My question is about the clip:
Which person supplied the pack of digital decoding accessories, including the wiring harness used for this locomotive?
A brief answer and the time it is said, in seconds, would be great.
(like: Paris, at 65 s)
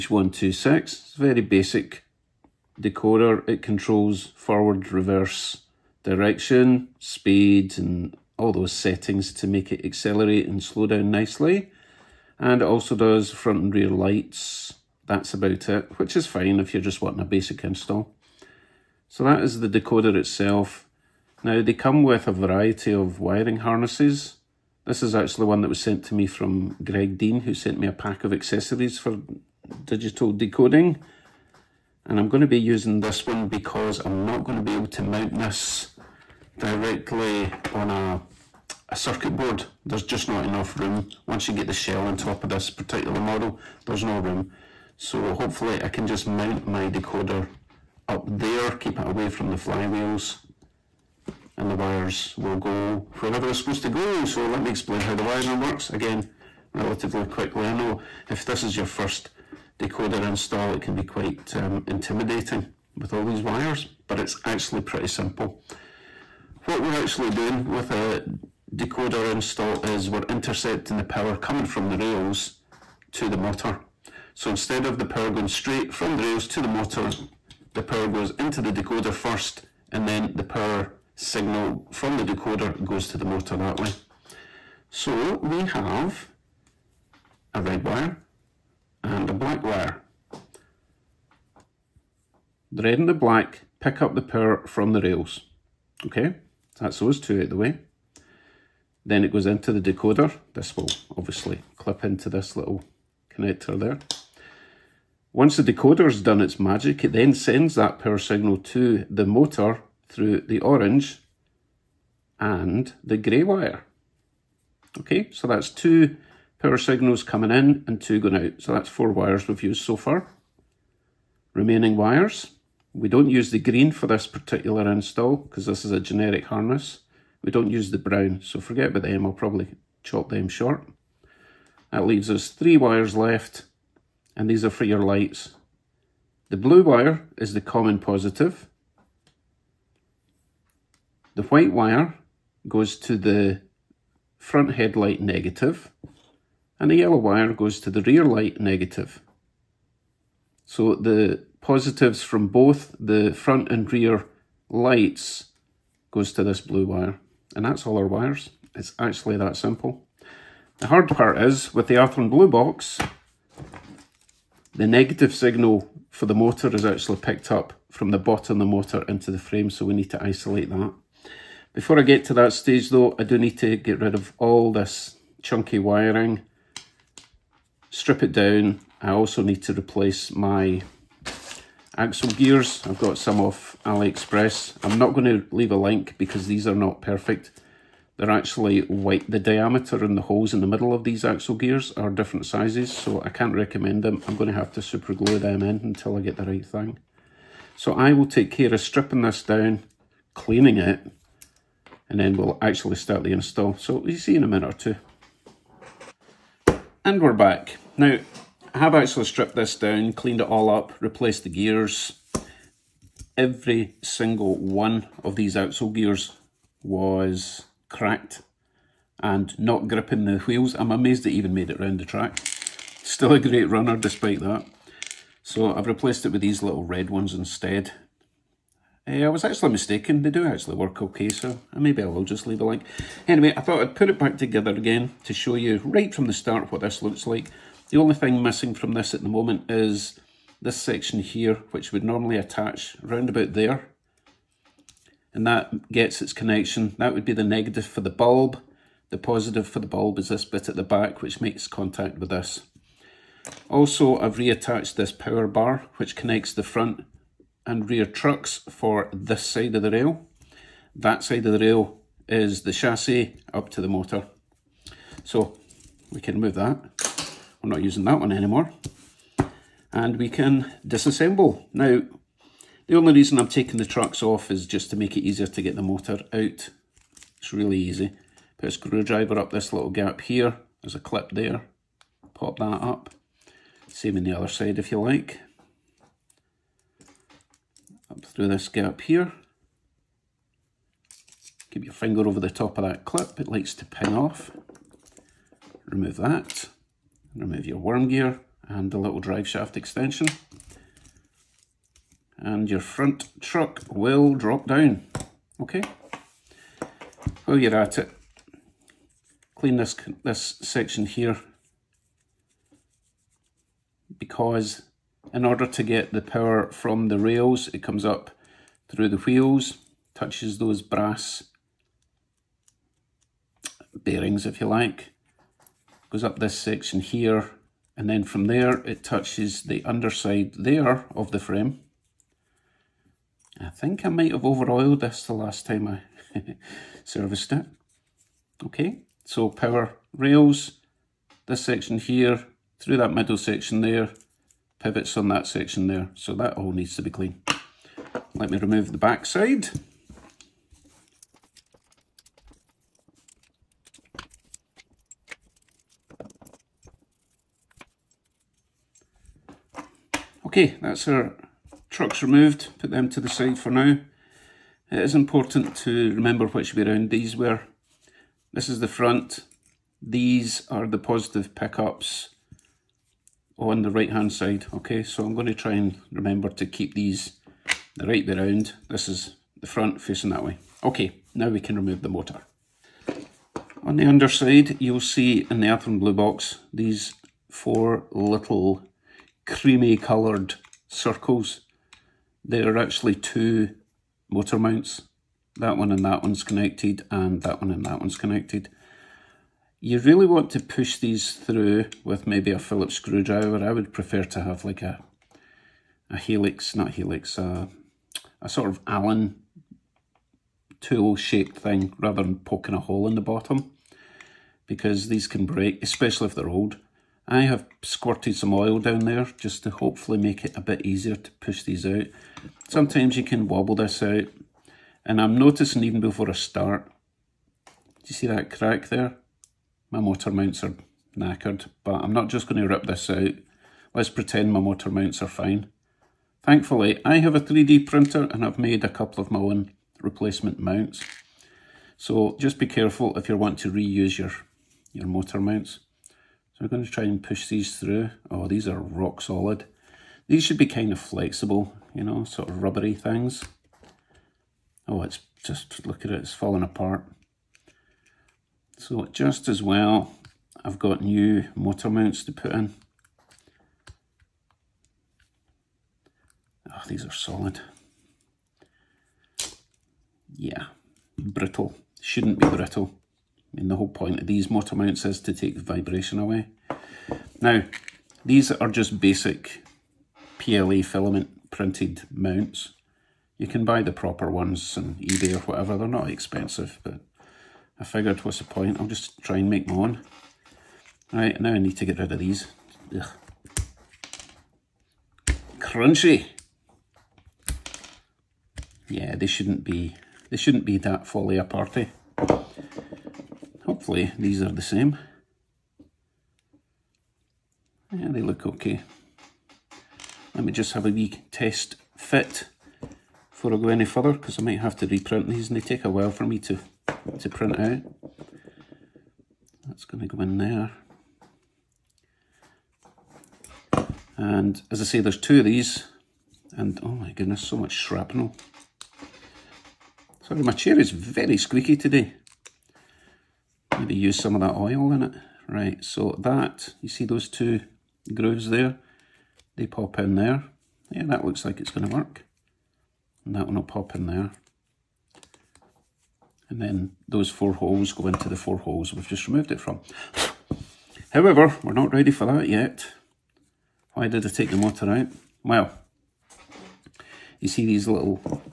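Greg Dean, at 26 s.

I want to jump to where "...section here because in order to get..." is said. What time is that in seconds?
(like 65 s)
310 s.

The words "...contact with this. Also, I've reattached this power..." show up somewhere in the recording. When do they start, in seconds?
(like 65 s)
251 s.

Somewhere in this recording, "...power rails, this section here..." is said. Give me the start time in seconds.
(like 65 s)
339 s.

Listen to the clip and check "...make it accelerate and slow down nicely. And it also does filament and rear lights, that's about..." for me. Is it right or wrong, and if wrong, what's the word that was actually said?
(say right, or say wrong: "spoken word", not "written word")
wrong: "front", not "filament".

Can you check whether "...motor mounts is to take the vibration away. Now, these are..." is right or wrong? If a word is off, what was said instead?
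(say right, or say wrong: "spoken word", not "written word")
right.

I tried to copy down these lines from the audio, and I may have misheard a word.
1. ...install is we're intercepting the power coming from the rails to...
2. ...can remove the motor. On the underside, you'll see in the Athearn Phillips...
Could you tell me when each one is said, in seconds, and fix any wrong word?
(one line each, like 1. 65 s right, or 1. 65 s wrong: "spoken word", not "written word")
1. 69 s right
2. 381 s wrong: "Blue", not "Phillips".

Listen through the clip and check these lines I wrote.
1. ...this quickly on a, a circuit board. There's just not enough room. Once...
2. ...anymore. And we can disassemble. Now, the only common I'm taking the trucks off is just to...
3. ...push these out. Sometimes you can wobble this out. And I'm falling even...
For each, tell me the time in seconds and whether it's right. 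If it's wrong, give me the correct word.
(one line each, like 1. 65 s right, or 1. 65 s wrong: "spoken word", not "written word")
1. 35 s wrong: "directly", not "quickly"
2. 268 s wrong: "reason", not "common"
3. 421 s wrong: "noticing", not "falling".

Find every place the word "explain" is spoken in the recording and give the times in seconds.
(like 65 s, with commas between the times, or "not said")
54 s.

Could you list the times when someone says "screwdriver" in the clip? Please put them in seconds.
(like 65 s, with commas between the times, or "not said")
278 s, 402 s.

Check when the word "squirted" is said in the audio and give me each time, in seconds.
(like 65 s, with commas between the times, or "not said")
417 s.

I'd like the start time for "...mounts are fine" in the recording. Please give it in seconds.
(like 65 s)
434 s.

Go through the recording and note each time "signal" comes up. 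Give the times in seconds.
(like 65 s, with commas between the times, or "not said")
81 s, 108 s, 116 s, 165 s.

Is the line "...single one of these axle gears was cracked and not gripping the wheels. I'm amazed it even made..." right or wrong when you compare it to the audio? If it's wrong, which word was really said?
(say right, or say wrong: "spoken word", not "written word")
right.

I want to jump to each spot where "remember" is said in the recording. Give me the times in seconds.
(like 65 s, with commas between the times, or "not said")
366 s, 376 s.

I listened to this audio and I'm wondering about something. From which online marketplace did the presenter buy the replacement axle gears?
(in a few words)
AliExpress.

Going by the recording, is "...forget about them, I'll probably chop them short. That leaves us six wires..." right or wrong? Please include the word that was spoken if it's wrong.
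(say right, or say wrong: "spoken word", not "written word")
wrong: "three", not "six".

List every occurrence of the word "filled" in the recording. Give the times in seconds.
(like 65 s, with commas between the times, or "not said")
not said.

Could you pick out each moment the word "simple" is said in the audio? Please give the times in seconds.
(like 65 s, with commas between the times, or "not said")
65 s, 159 s.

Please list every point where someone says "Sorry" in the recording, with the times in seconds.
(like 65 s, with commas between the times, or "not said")
530 s.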